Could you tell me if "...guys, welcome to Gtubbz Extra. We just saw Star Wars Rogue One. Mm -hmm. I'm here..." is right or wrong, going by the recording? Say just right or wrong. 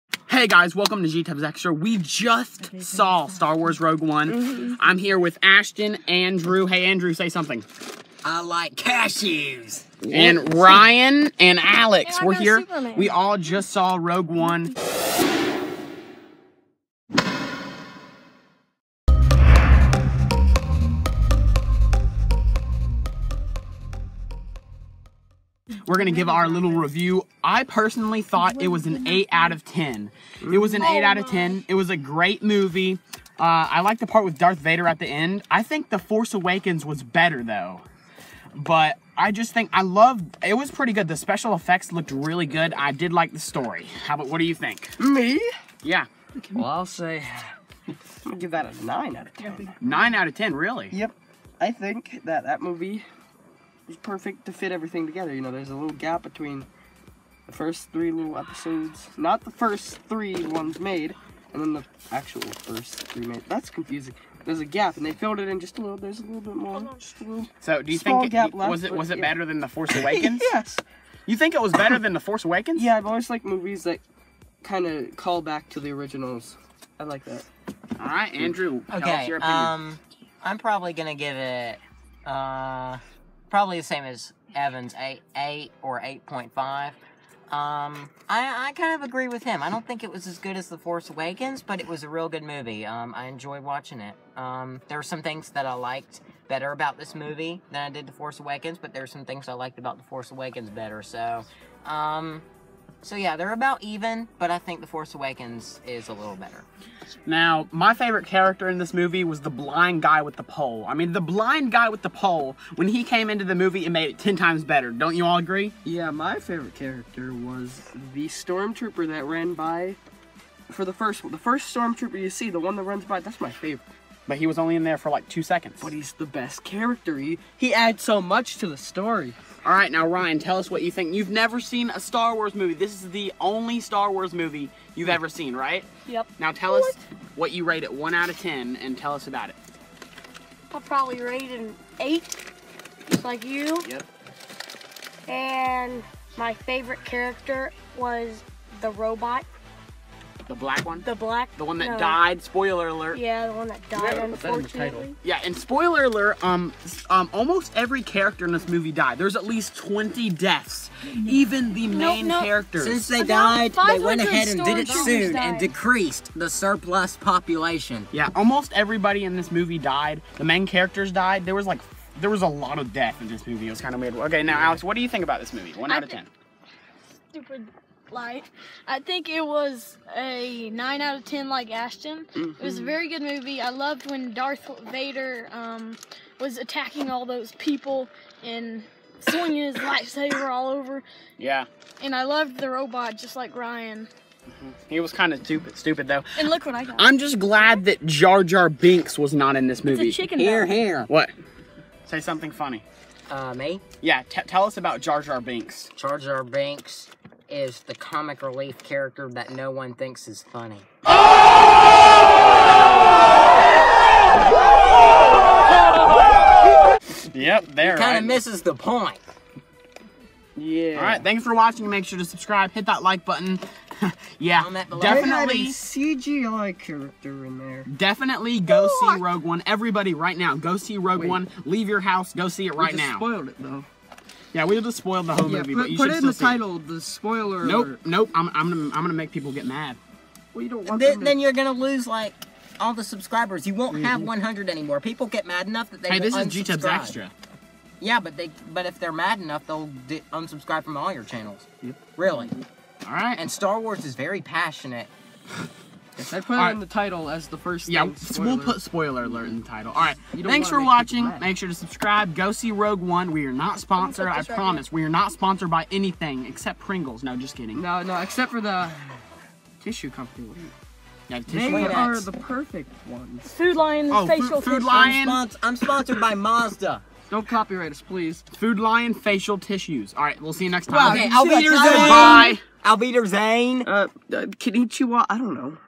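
right.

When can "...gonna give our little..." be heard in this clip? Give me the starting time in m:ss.
0:25.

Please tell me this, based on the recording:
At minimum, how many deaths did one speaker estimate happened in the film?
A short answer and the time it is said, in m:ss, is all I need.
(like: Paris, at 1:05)
20, at 2:39.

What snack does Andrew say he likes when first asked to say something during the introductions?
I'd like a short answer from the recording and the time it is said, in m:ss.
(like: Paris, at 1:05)
Cashews, at 0:08.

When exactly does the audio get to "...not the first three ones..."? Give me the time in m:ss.
0:59.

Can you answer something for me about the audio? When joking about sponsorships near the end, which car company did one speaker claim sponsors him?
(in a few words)
Mazda.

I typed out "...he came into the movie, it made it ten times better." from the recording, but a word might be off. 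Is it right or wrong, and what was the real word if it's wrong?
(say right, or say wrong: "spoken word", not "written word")
right.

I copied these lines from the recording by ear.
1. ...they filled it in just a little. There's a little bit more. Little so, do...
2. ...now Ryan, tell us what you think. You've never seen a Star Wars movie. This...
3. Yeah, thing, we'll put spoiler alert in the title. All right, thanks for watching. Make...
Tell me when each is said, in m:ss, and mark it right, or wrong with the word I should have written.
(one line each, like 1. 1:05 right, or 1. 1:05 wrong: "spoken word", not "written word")
1. 1:05 right
2. 2:09 right
3. 4:17 right.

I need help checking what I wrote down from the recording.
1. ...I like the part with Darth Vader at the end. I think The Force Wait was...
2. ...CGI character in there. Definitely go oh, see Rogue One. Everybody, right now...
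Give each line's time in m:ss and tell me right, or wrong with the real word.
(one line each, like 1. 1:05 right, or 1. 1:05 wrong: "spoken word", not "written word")
1. 0:33 wrong: "Awakens", not "Wait"
2. 3:45 right.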